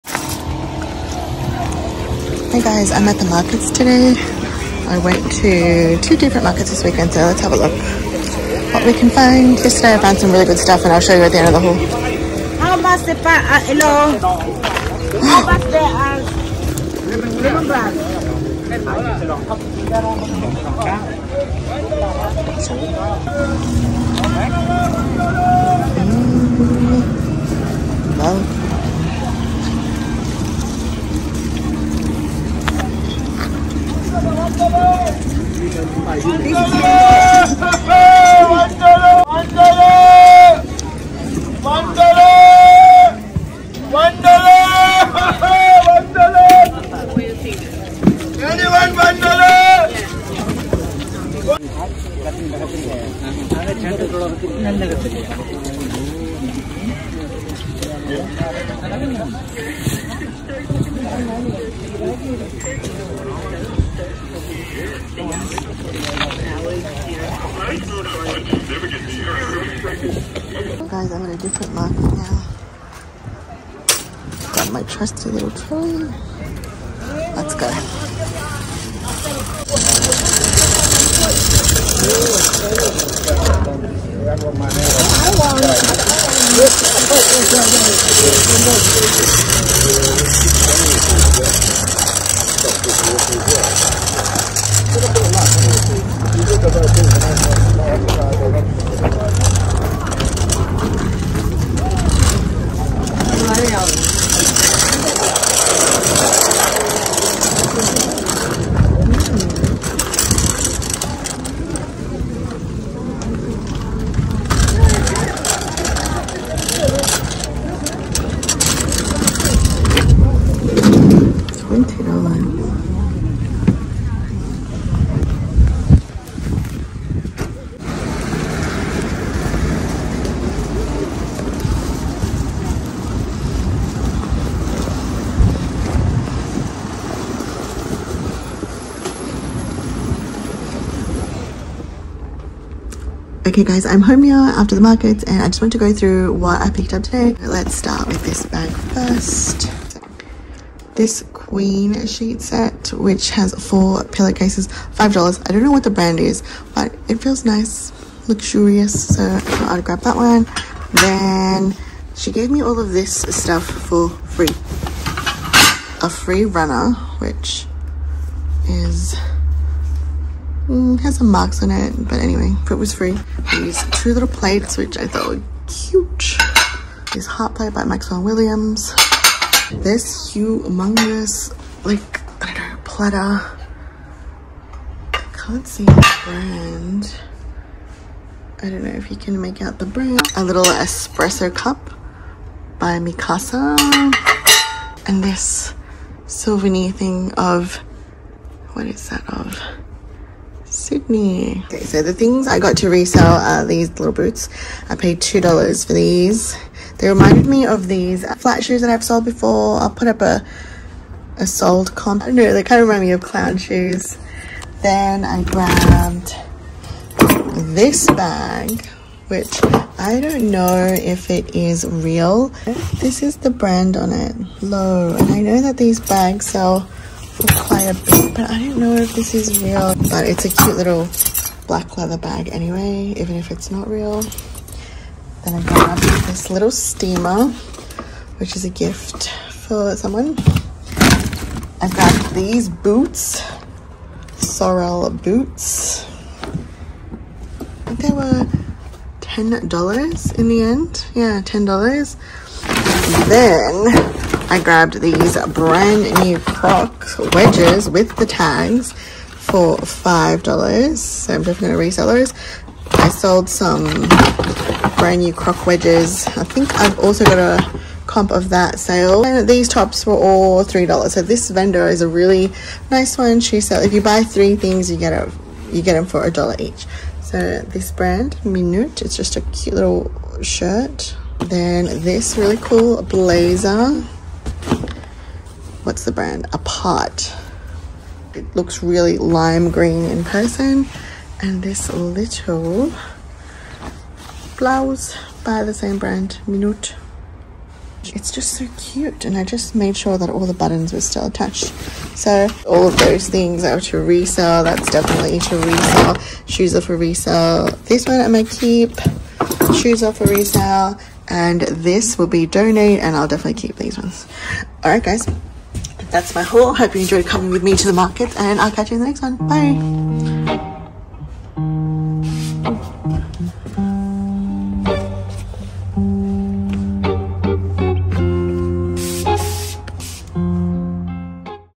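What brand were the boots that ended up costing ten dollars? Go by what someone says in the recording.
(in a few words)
Sorel.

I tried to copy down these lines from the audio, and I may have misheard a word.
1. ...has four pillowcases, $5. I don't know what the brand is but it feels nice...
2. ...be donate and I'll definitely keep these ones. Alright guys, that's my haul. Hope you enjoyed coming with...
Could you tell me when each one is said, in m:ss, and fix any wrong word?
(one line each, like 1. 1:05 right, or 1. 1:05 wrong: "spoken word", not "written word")
1. 2:33 right
2. 5:12 right.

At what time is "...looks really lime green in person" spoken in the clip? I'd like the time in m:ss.
4:48.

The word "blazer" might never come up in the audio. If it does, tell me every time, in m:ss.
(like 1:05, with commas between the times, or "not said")
4:43.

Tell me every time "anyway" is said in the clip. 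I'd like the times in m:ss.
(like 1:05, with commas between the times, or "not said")
2:52, 3:52.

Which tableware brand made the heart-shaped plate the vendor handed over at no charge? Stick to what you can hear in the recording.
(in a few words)
Maxwell Williams.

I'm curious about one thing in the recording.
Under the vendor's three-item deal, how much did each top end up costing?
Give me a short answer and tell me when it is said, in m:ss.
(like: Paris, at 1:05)
a dollar each, at 4:36.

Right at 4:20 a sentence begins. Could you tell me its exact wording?
So I'm definitely going to resell those.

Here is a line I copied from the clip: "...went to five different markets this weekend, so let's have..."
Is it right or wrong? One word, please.
wrong.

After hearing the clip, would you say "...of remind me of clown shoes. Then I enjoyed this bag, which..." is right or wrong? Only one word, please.
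wrong.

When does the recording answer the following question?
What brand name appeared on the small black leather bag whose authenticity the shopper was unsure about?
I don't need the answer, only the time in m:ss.
3:44.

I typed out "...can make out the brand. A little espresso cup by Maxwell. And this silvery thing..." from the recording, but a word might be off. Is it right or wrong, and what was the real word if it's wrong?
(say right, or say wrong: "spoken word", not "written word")
wrong: "Mikasa", not "Maxwell".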